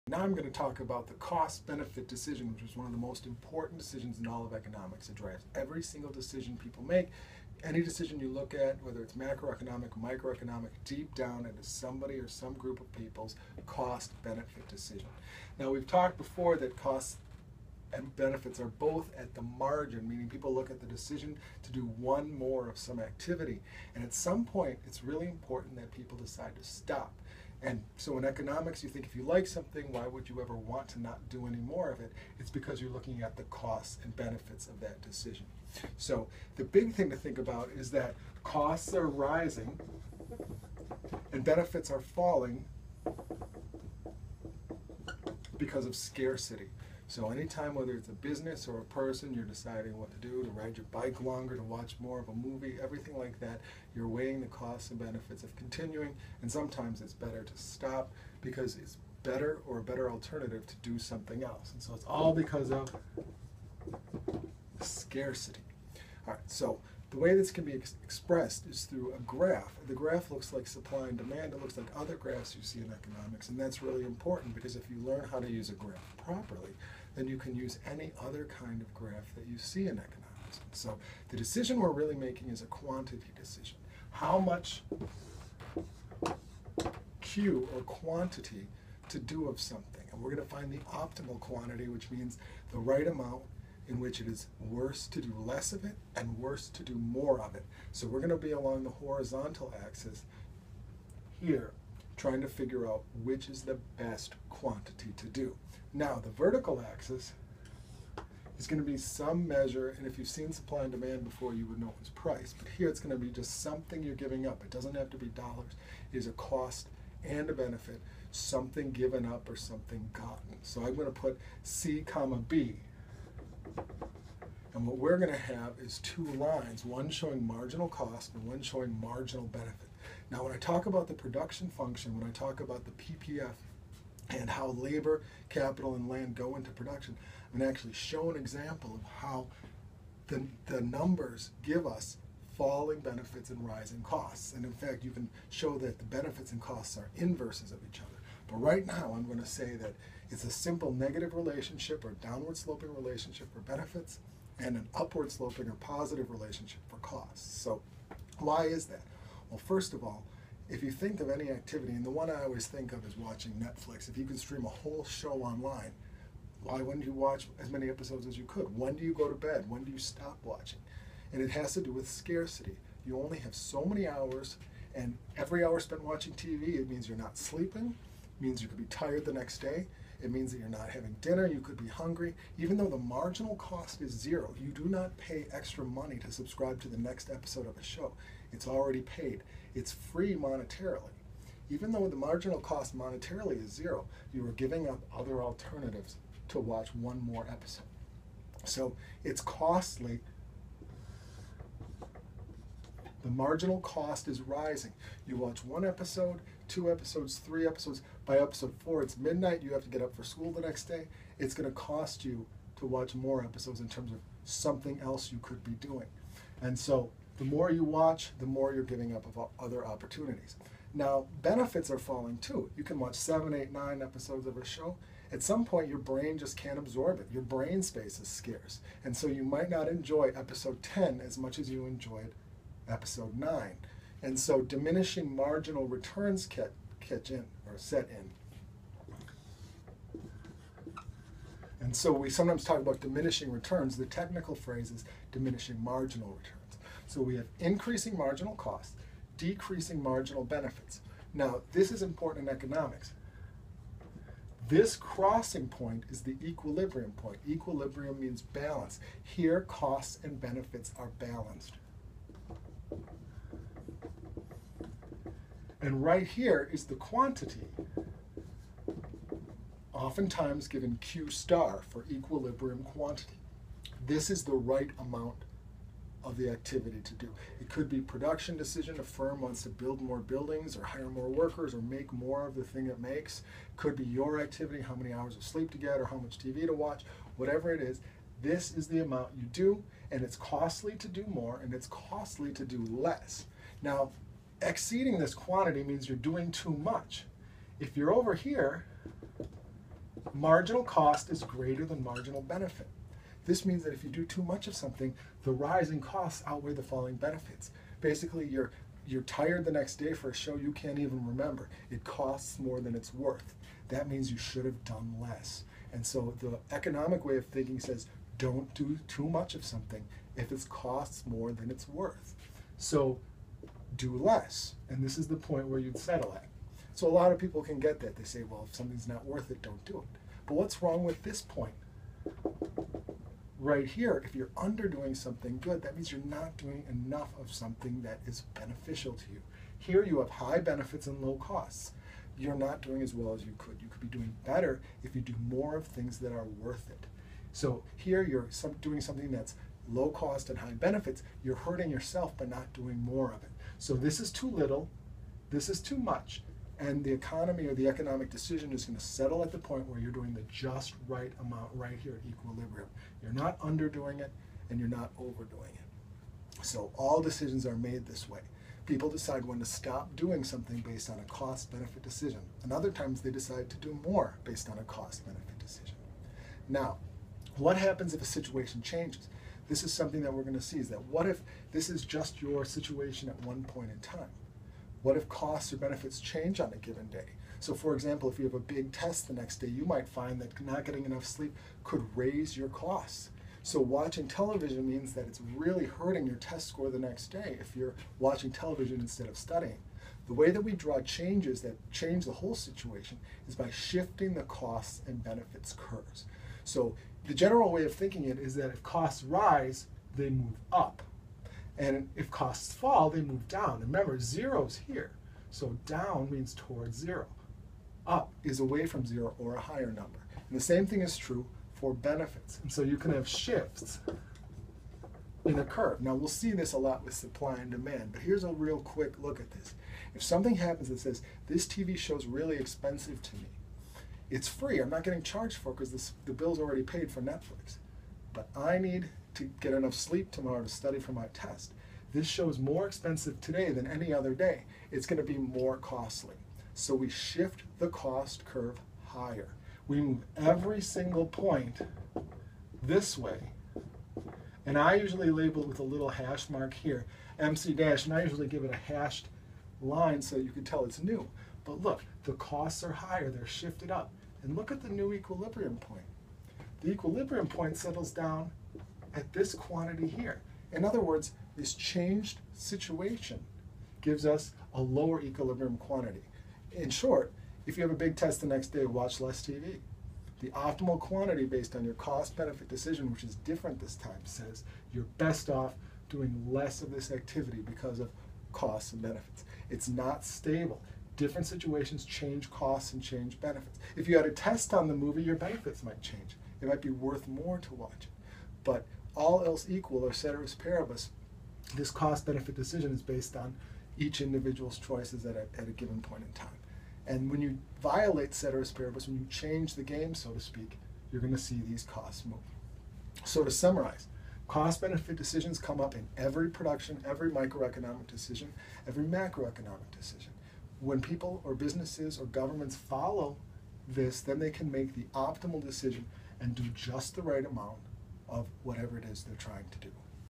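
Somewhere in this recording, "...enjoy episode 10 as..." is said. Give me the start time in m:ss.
3:49.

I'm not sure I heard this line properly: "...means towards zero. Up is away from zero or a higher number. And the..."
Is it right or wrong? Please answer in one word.
right.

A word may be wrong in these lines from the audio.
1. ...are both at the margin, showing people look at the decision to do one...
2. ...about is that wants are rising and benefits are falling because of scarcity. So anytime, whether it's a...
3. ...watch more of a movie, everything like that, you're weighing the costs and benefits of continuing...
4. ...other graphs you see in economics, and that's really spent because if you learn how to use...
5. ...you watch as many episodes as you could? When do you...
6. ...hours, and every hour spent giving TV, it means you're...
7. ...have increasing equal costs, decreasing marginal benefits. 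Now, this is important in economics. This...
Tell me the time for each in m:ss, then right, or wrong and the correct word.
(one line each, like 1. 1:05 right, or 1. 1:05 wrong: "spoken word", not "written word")
1. 0:18 wrong: "meaning", not "showing"
2. 0:37 wrong: "costs", not "wants"
3. 0:51 right
4. 1:11 wrong: "important", not "spent"
5. 2:47 right
6. 2:54 wrong: "watching", not "giving"
7. 4:07 wrong: "marginal", not "equal".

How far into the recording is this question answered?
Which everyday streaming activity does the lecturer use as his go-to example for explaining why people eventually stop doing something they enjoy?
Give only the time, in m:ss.
2:43.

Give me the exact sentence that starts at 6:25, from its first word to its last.
What if costs or benefits change on a given day?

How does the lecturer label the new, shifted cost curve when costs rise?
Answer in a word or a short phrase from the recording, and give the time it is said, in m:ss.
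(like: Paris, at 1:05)
MC dash, at 7:37.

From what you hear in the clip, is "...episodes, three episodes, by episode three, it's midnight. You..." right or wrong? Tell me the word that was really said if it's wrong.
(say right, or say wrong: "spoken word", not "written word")
wrong: "four", not "three".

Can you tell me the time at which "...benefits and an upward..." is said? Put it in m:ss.
2:33.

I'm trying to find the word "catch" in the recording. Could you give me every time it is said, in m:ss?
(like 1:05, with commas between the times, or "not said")
3:56.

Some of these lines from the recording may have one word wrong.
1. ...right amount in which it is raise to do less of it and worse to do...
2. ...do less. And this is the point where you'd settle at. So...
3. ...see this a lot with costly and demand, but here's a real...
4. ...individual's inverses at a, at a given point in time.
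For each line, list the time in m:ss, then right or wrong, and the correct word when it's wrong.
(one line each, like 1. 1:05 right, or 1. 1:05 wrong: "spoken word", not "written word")
1. 1:32 wrong: "worse", not "raise"
2. 5:23 right
3. 7:06 wrong: "supply", not "costly"
4. 8:24 wrong: "choices", not "inverses".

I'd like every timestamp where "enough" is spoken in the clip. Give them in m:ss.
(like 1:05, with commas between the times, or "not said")
5:36, 6:31, 7:19.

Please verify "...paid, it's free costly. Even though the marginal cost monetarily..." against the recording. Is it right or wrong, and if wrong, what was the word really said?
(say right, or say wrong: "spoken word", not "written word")
wrong: "monetarily", not "costly".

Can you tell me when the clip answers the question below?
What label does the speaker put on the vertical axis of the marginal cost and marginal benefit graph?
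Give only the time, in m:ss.
2:01.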